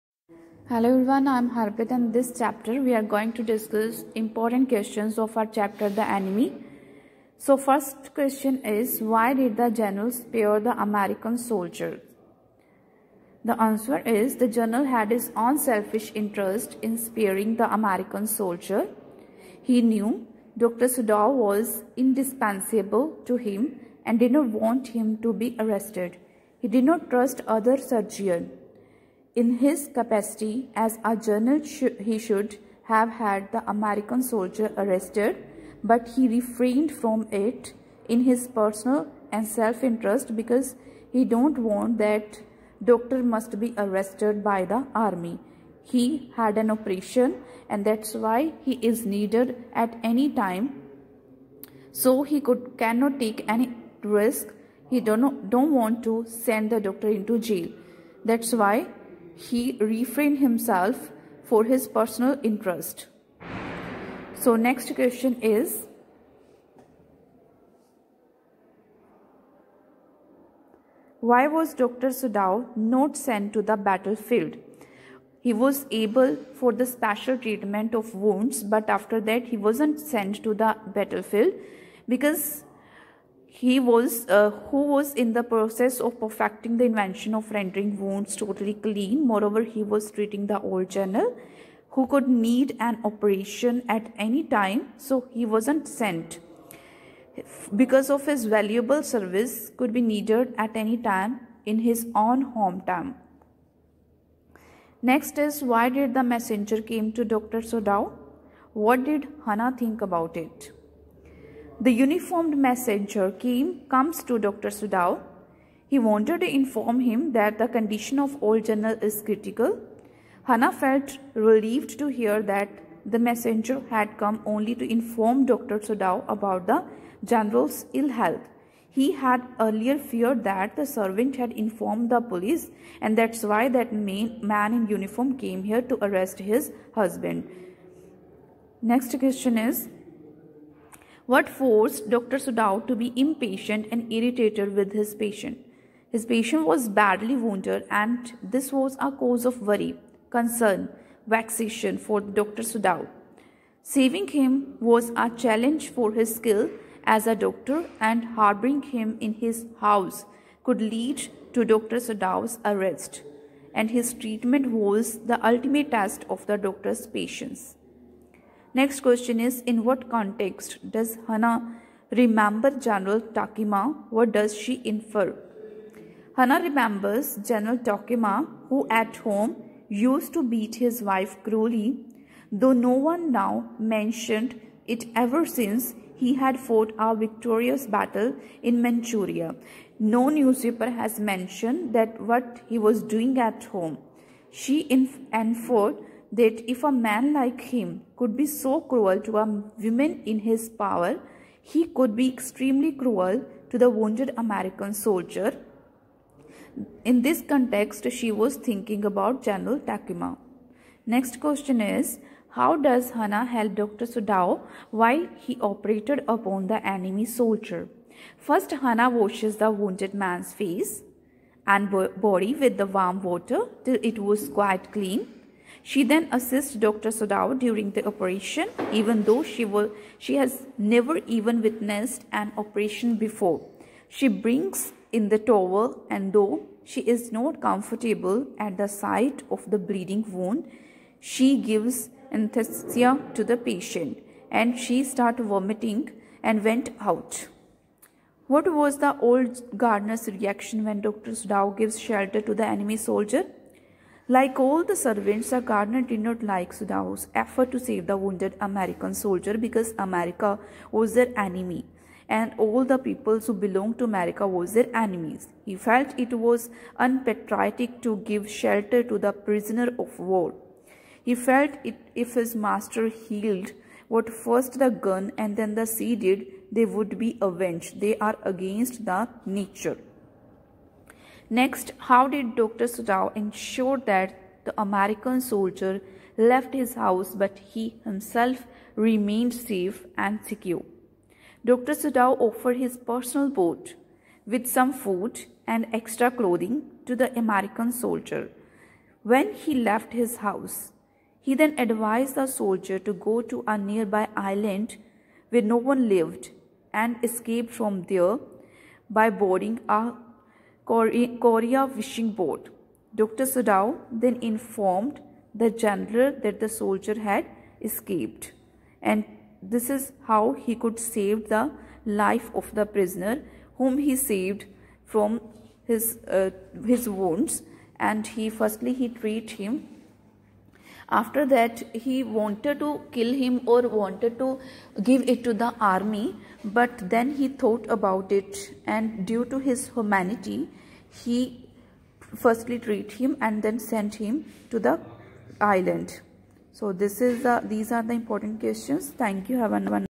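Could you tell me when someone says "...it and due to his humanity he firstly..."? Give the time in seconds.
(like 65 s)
338 s.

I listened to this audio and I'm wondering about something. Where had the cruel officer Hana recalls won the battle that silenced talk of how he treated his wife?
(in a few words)
Manchuria.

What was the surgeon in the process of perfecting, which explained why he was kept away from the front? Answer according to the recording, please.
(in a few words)
Rendering wounds totally clean.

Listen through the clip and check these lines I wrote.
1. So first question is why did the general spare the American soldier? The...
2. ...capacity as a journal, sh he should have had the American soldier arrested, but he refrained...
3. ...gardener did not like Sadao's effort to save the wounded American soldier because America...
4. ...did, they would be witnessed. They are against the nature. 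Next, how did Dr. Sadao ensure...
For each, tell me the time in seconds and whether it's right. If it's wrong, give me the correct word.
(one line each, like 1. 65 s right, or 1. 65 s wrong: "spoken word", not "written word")
1. 7 s right
2. 29 s right
3. 255 s right
4. 276 s wrong: "avenged", not "witnessed".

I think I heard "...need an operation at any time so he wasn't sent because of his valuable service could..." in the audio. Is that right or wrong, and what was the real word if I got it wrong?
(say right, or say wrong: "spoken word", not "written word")
right.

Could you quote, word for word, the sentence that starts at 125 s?
Sadao about the general's ill health.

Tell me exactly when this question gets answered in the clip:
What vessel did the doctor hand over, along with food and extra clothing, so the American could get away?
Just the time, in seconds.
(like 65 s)
292 s.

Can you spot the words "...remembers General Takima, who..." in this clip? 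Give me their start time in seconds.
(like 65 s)
176 s.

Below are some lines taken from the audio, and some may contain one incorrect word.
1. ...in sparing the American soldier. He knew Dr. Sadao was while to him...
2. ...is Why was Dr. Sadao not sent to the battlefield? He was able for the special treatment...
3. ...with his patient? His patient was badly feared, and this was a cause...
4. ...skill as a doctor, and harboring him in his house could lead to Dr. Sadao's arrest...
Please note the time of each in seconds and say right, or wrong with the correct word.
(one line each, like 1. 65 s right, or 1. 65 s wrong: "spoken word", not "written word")
1. 16 s wrong: "indispensable", not "while"
2. 65 s right
3. 144 s wrong: "wounded", not "feared"
4. 156 s right.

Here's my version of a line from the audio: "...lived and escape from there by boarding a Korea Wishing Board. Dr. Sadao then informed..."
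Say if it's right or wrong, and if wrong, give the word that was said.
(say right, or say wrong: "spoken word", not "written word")
right.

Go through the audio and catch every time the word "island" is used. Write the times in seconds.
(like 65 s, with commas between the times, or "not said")
304 s, 345 s.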